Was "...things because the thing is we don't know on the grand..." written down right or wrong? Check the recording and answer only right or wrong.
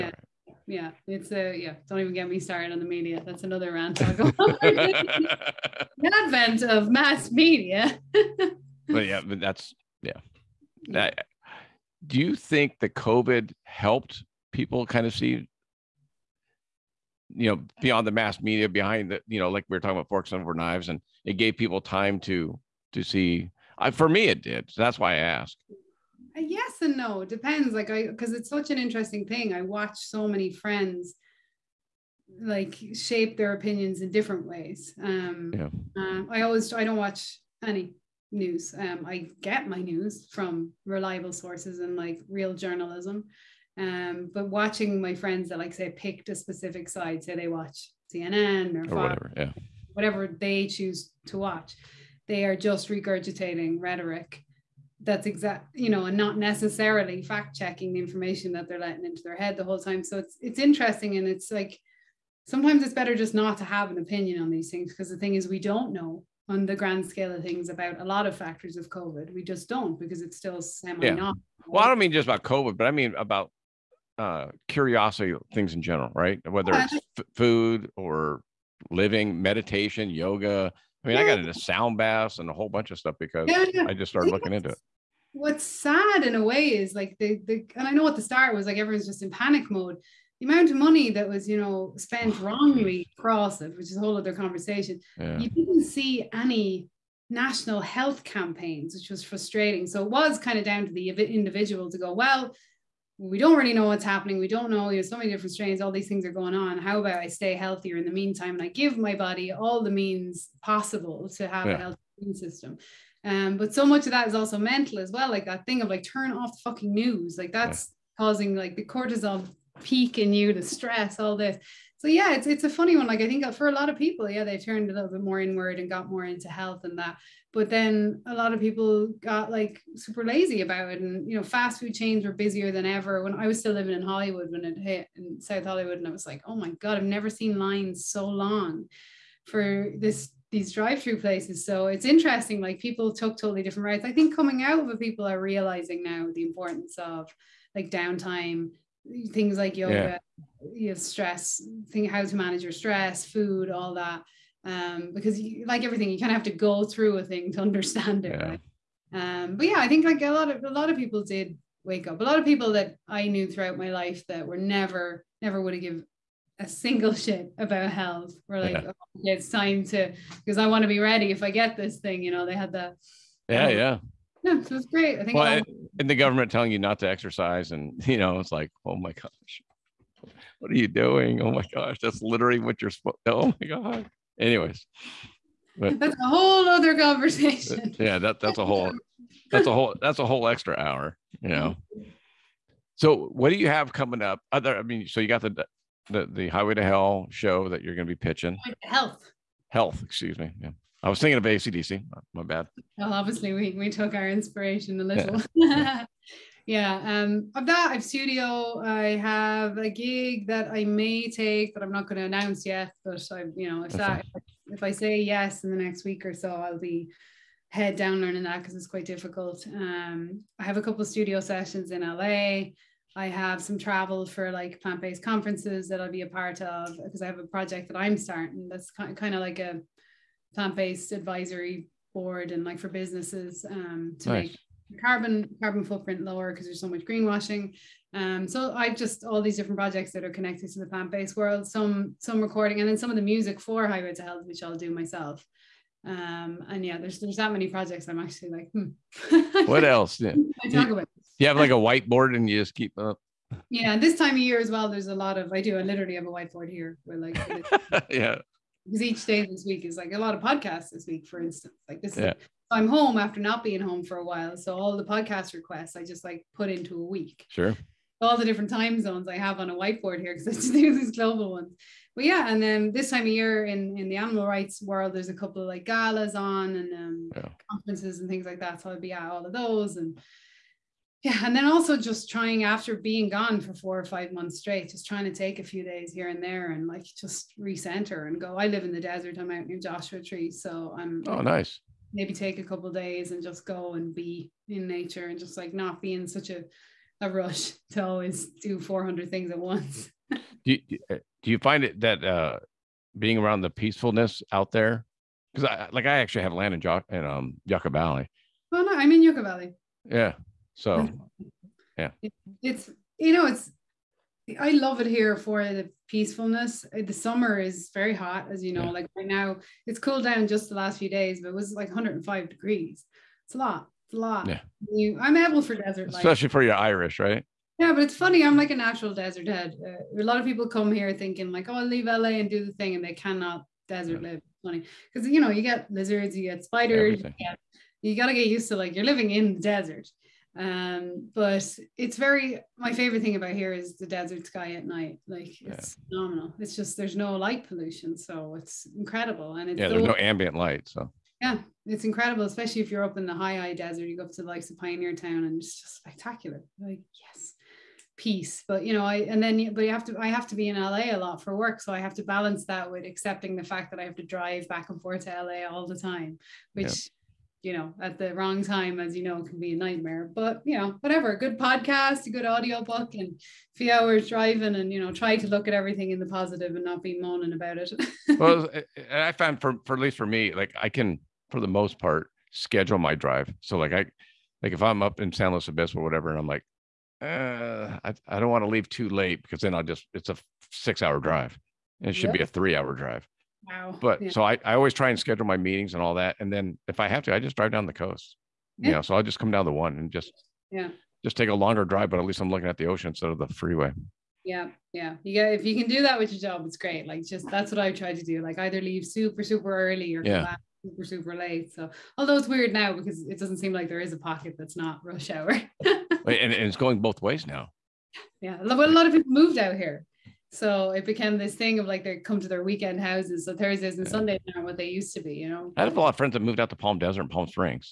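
right.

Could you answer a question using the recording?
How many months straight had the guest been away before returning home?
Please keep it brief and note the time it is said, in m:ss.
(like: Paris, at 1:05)
Four or five months, at 4:43.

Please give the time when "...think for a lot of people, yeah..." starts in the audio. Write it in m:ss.
2:03.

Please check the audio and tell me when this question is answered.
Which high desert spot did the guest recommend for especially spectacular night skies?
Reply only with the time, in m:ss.
5:54.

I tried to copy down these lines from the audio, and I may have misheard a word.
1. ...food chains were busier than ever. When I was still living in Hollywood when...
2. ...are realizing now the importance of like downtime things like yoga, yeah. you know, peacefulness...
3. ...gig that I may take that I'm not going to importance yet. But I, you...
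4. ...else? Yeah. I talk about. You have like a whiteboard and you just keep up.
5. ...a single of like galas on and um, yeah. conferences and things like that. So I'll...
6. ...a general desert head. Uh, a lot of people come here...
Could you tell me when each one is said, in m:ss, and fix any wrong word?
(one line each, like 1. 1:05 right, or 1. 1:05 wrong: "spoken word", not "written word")
1. 2:11 right
2. 2:25 wrong: "stress", not "peacefulness"
3. 3:29 wrong: "announce", not "importance"
4. 4:09 right
5. 4:35 wrong: "couple", not "single"
6. 5:28 wrong: "natural", not "general".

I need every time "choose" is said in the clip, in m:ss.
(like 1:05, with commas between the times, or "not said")
0:50.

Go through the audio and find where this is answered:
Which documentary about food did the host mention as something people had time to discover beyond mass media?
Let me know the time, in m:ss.
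0:20.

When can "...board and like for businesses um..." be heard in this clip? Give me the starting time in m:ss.
3:52.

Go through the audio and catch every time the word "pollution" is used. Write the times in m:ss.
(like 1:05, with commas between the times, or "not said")
5:47.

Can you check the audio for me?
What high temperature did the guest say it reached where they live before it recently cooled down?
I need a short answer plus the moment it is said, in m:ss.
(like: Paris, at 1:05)
105 degrees, at 5:21.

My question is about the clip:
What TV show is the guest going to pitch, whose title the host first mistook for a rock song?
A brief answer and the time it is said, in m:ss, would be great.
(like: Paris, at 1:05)
Highway to Health, at 4:03.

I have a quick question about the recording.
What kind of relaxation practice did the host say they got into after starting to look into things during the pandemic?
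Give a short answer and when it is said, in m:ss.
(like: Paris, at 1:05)
Sound baths, at 1:21.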